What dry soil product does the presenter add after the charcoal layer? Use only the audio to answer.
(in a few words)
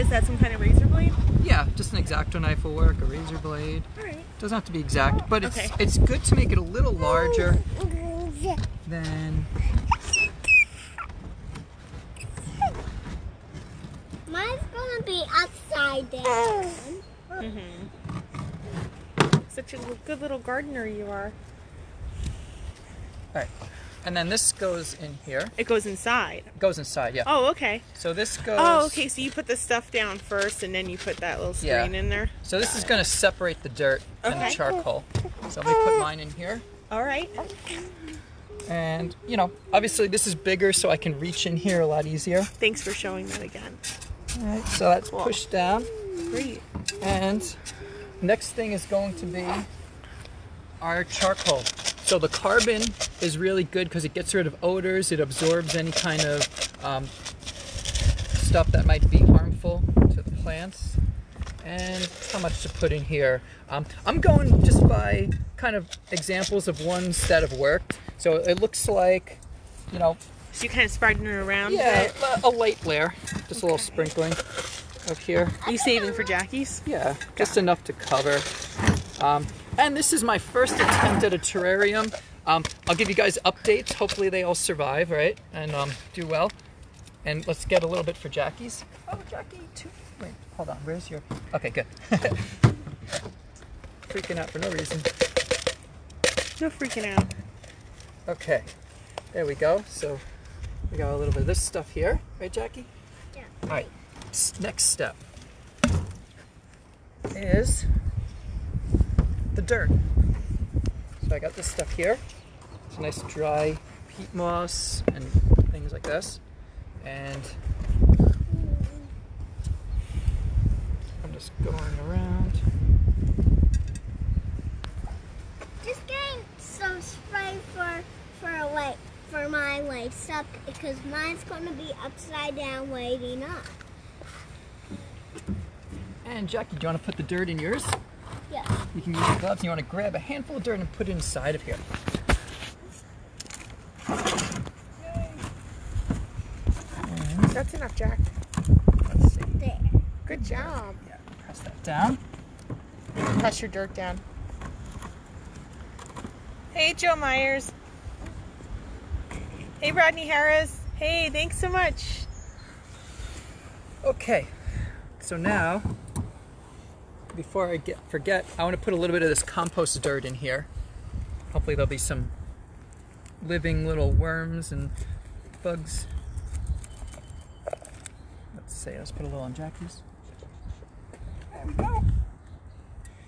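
Peat moss.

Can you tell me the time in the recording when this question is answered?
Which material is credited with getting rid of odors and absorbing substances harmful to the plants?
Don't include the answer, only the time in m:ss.
0:52.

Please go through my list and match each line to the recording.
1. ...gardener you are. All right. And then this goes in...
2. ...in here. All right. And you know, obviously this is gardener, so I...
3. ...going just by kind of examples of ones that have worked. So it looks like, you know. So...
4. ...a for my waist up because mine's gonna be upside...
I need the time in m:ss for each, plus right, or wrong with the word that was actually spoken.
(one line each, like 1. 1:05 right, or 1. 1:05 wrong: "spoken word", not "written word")
1. 0:20 right
2. 0:36 wrong: "bigger", not "gardener"
3. 1:04 right
4. 2:08 right.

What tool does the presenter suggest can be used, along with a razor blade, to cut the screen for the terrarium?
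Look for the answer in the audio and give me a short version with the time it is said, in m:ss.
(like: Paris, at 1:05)
Exacto knife, at 0:02.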